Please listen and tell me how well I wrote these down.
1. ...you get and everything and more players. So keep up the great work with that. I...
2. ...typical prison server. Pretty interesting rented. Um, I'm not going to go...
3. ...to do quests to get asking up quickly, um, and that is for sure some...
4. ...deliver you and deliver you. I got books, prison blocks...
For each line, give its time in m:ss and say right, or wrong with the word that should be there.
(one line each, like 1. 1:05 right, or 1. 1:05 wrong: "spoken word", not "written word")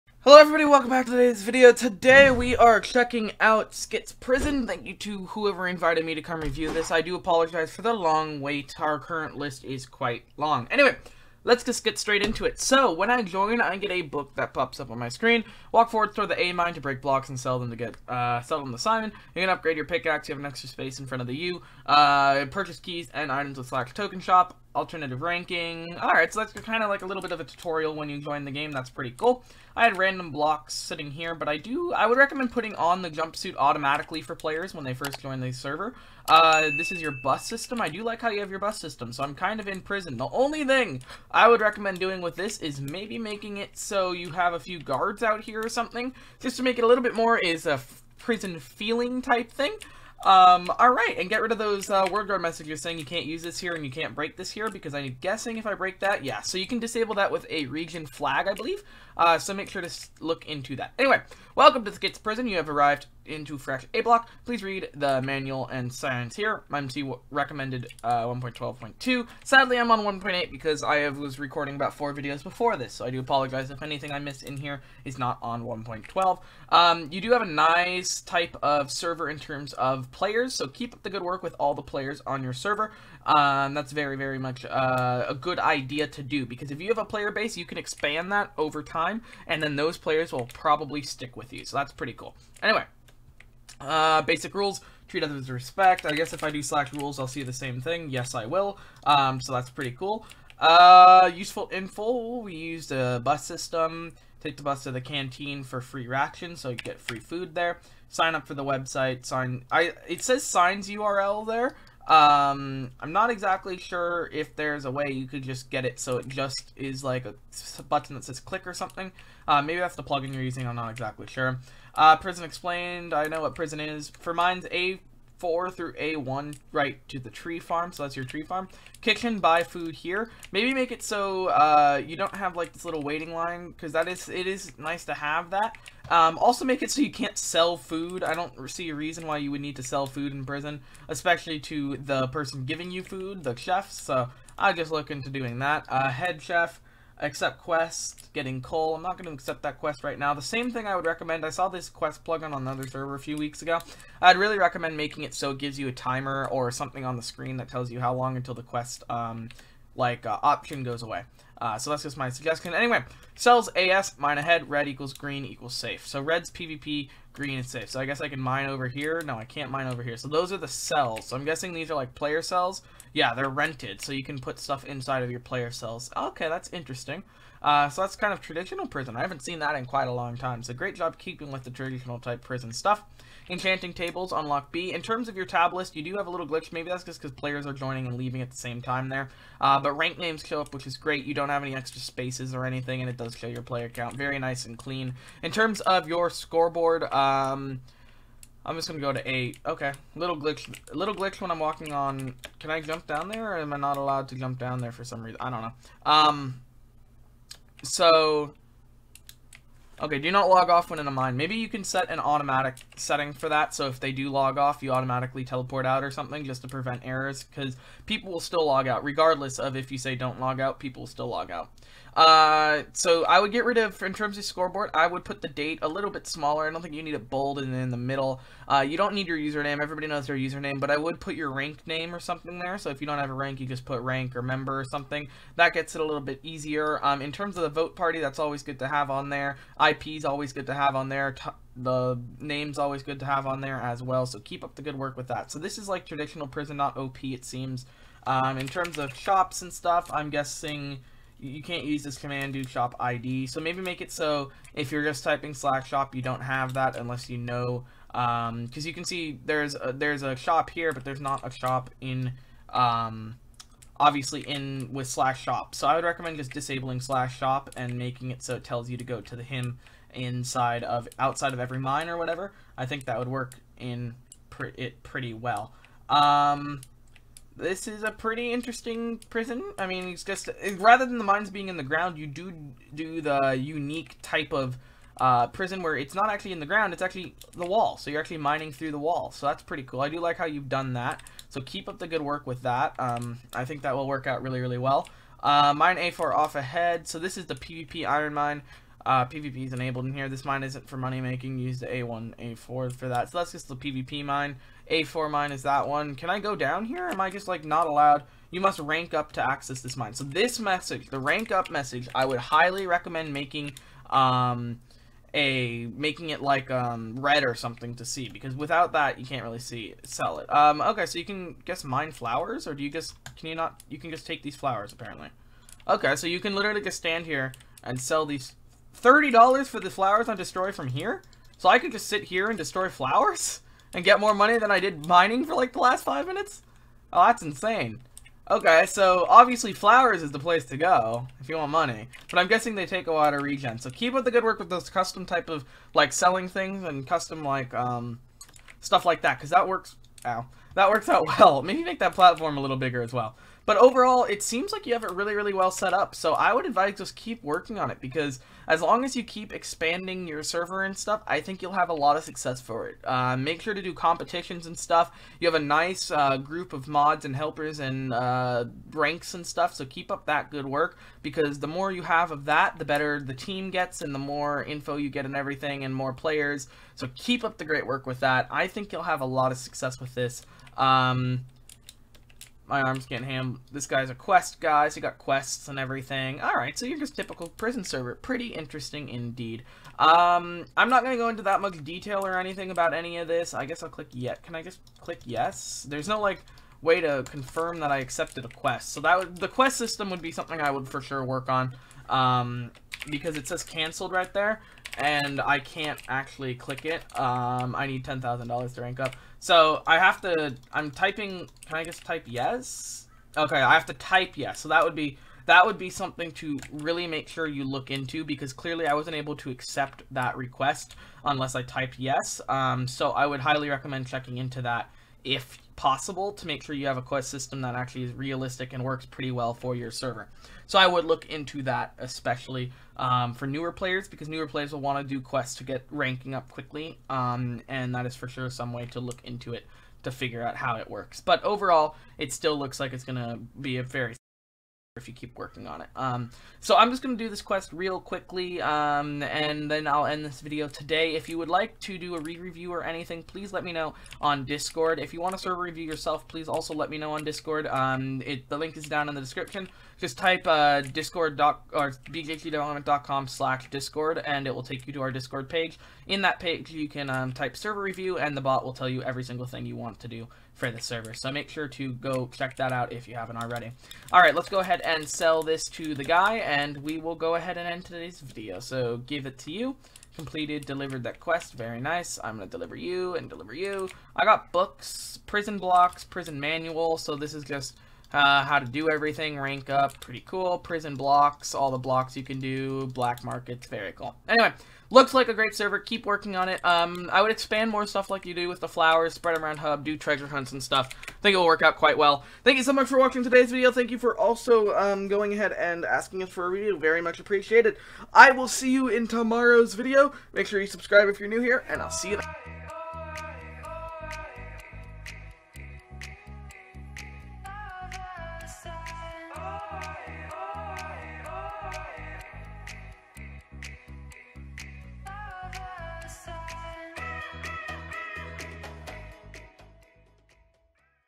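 1. 6:14 right
2. 6:27 wrong: "indeed", not "rented"
3. 7:15 wrong: "ranking", not "asking"
4. 8:02 right.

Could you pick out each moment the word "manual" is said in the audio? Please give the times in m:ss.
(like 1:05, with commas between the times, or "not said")
1:05, 8:06.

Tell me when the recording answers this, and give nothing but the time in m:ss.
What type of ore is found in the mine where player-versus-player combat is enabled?
4:58.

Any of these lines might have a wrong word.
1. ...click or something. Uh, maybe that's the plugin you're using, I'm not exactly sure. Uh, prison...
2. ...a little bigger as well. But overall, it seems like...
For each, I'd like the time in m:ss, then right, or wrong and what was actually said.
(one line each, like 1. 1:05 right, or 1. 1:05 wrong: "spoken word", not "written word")
1. 1:58 right
2. 5:52 right.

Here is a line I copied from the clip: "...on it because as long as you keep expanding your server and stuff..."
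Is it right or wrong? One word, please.
right.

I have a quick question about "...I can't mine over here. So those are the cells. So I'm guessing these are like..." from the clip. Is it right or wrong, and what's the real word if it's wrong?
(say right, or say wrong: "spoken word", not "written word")
right.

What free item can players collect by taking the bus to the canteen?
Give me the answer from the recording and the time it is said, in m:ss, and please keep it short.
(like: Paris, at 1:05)
ration, at 1:45.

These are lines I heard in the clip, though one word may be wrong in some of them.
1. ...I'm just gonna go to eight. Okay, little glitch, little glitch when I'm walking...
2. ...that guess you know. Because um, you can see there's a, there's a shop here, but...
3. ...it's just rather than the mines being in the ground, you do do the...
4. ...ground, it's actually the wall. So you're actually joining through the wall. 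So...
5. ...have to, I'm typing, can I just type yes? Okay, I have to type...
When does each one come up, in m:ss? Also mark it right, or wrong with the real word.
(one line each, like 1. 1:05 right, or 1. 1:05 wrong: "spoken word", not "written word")
1. 3:18 right
2. 4:16 wrong: "unless", not "guess"
3. 4:40 right
4. 4:46 wrong: "mining", not "joining"
5. 6:49 right.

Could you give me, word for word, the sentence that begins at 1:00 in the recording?
Anyway, Welcome to the Skits Prison.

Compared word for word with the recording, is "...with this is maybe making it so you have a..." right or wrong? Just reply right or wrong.
right.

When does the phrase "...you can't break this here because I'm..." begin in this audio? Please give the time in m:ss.
0:53.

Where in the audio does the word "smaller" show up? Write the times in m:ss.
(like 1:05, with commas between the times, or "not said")
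3:46.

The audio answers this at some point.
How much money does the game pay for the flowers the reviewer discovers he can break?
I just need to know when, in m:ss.
5:29.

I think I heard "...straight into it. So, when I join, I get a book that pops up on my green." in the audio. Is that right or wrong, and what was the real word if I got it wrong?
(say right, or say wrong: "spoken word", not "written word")
wrong: "screen", not "green".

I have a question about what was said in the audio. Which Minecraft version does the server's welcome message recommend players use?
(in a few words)
1.12.2.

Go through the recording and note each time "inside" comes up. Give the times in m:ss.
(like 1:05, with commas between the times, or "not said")
2:54, 4:30.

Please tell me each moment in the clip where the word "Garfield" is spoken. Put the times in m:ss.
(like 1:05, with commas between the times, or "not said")
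not said.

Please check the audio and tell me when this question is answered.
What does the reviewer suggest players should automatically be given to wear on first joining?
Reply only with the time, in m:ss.
0:33.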